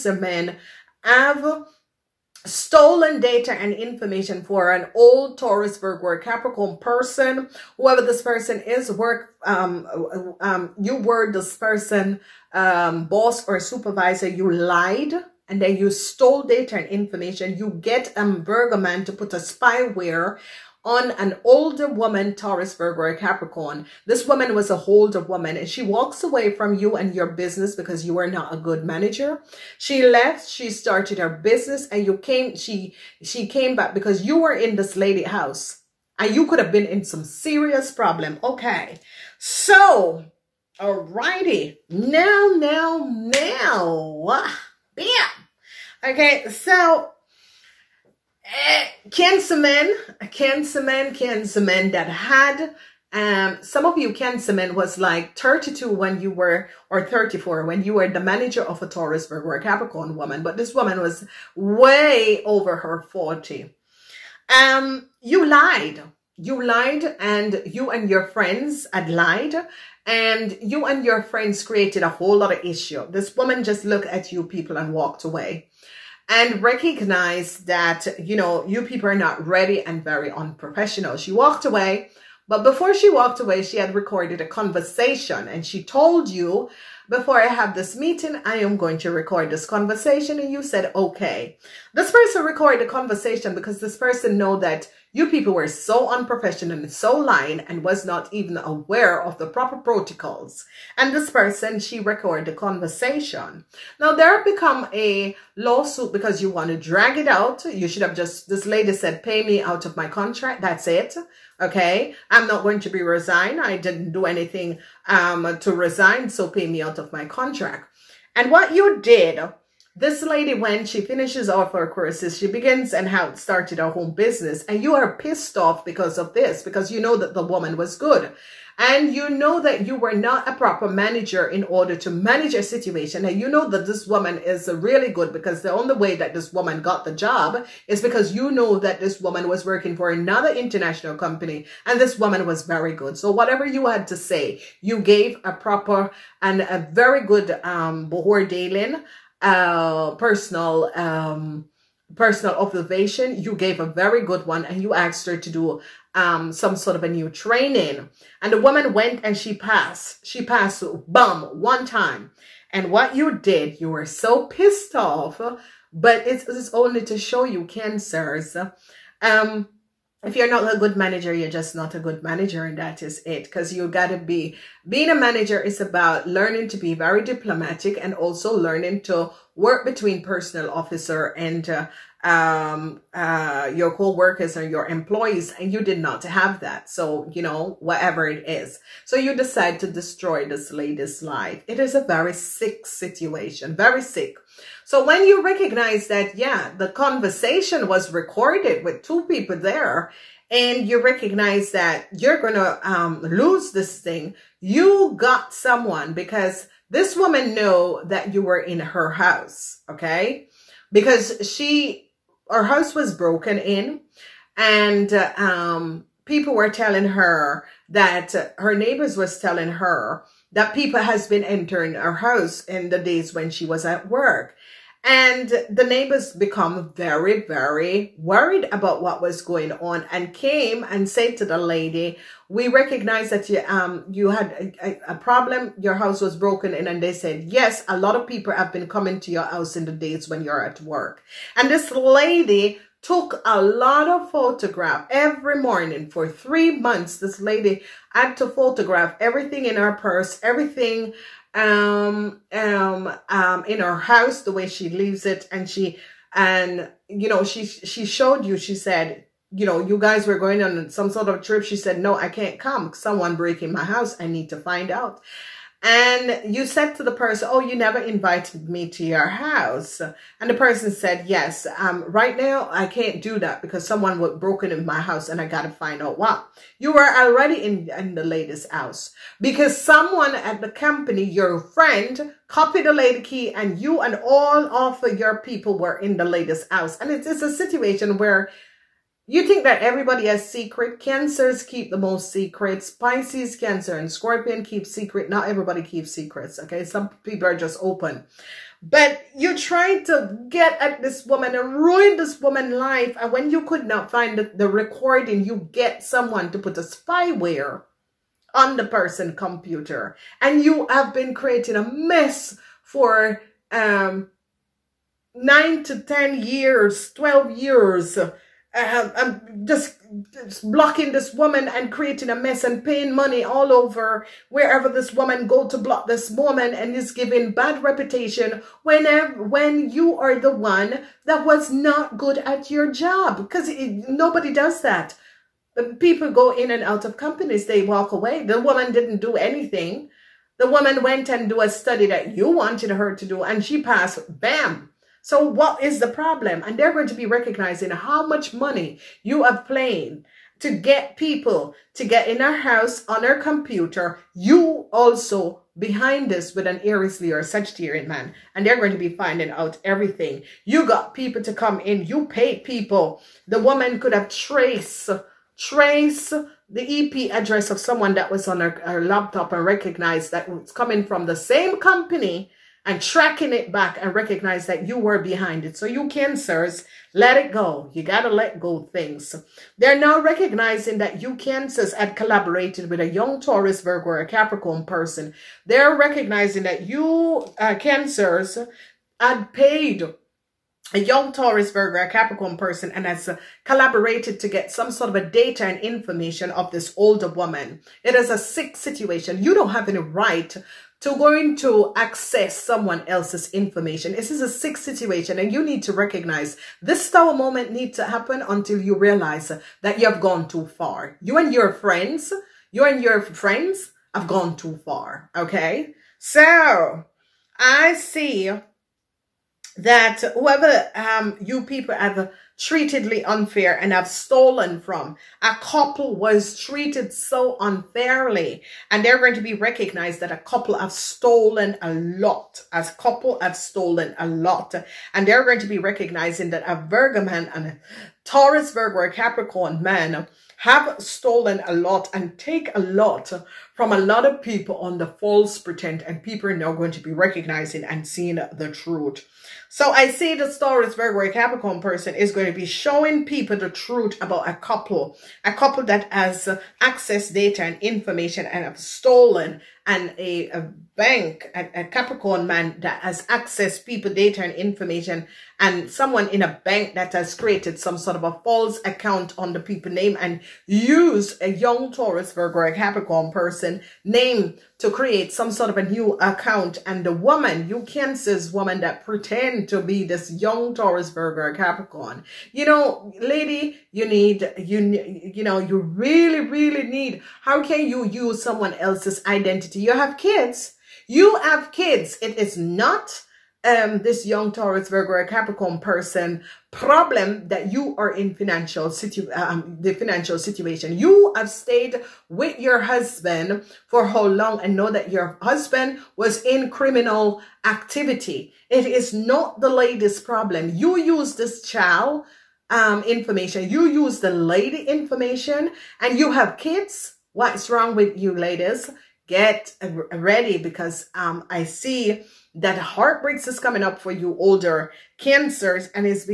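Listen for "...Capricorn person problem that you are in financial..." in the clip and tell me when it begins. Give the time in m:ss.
8:15.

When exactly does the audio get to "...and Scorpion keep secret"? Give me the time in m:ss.
4:53.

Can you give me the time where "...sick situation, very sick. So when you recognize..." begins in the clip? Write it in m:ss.
3:12.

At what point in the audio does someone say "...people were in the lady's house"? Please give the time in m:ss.
4:45.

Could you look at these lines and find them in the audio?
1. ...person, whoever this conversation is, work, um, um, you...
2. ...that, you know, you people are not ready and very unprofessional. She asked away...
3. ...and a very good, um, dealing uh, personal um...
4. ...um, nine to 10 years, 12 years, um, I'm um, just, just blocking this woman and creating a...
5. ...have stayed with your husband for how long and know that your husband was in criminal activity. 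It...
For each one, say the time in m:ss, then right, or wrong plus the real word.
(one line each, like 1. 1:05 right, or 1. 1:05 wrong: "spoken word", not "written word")
1. 0:06 wrong: "person", not "conversation"
2. 1:17 wrong: "walked", not "asked"
3. 2:26 right
4. 5:13 right
5. 8:21 right.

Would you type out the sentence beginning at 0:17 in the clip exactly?
You get a Virgo man to put a spyware on an older woman, Taurus, Virgo, Capricorn.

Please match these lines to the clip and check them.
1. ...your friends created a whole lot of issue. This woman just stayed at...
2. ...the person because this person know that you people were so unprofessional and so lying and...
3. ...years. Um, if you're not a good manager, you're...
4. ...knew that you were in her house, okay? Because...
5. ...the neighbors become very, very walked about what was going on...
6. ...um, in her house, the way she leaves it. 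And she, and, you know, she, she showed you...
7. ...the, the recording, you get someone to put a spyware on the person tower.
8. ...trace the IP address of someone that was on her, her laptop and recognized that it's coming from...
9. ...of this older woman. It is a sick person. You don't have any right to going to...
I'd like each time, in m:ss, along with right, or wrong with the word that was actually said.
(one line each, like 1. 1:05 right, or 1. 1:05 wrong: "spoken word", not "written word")
1. 1:11 wrong: "looked", not "stayed"
2. 1:32 wrong: "conversation", not "person"
3. 2:47 wrong: "cancers", not "years"
4. 3:27 right
5. 3:45 wrong: "worried", not "walked"
6. 4:13 right
7. 5:04 wrong: "computer", not "tower"
8. 6:05 right
9. 6:36 wrong: "situation", not "person".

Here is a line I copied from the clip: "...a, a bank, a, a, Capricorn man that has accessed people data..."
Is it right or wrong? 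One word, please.
right.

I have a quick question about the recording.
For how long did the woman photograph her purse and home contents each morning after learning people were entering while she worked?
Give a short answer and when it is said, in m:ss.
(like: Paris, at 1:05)
3 months, at 4:06.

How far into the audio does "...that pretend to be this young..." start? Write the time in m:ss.
7:58.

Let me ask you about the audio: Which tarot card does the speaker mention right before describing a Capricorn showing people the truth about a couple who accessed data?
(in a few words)
The Star.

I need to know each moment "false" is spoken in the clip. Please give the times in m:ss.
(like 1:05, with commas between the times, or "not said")
7:25, 7:48.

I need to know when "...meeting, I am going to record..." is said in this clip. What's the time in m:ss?
1:27.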